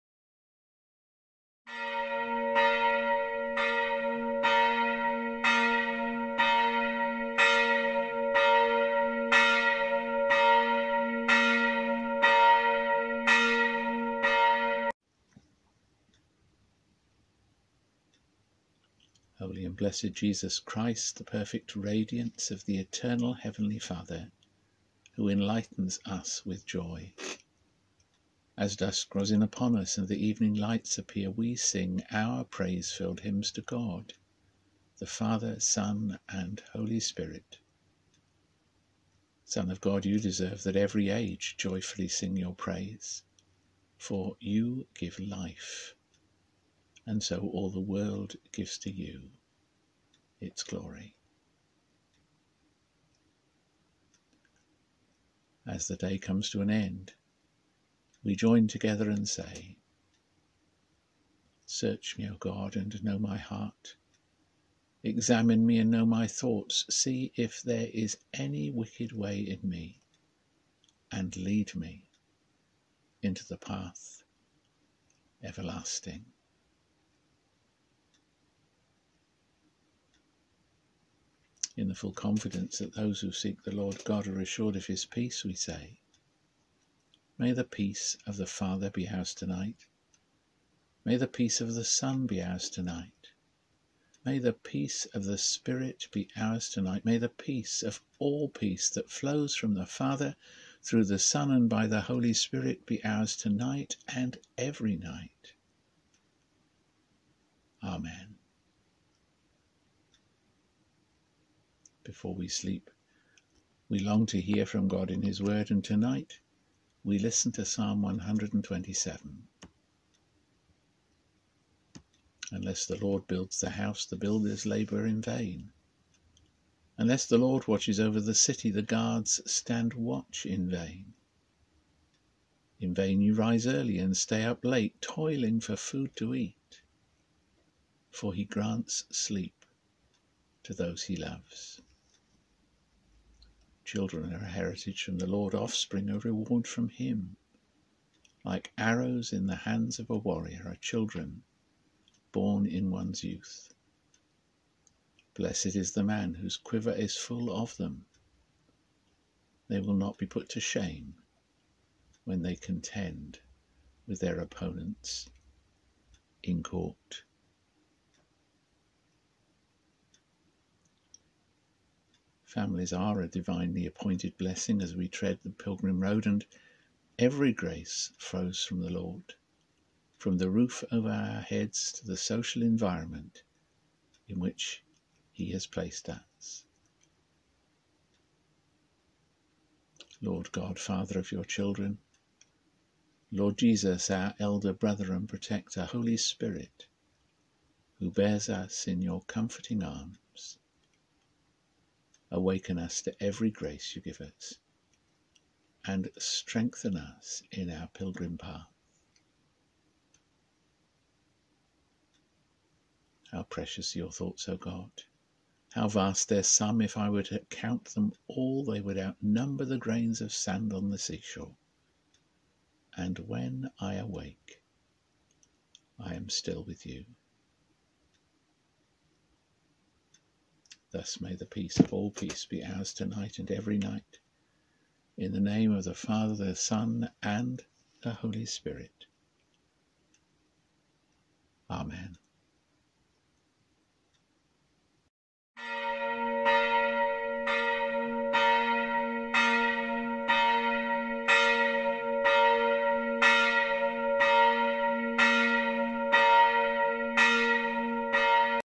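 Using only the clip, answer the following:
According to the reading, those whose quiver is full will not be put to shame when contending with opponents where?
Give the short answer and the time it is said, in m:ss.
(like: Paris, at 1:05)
In court, at 2:46.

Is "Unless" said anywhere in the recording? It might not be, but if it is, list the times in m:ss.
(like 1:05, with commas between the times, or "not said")
2:02, 2:06.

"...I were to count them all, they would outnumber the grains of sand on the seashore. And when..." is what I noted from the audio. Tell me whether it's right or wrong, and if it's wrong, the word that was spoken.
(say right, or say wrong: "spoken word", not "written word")
right.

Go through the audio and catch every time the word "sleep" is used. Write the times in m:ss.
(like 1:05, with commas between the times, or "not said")
1:52, 2:19.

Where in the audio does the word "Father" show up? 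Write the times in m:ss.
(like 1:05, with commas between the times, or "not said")
0:23, 0:35, 1:28, 1:39, 3:10, 3:55.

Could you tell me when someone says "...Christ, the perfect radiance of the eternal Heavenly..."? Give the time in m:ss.
0:20.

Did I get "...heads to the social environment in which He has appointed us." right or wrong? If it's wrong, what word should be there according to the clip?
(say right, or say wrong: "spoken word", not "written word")
wrong: "placed", not "appointed".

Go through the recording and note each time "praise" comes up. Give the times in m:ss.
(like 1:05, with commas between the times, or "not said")
0:32, 0:42.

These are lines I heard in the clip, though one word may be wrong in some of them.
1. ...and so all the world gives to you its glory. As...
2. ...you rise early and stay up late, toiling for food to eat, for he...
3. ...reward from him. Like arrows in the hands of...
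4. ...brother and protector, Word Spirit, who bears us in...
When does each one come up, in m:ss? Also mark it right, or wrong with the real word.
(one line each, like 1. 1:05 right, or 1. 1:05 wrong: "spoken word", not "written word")
1. 0:47 right
2. 2:13 right
3. 2:26 right
4. 3:14 wrong: "Holy", not "Word".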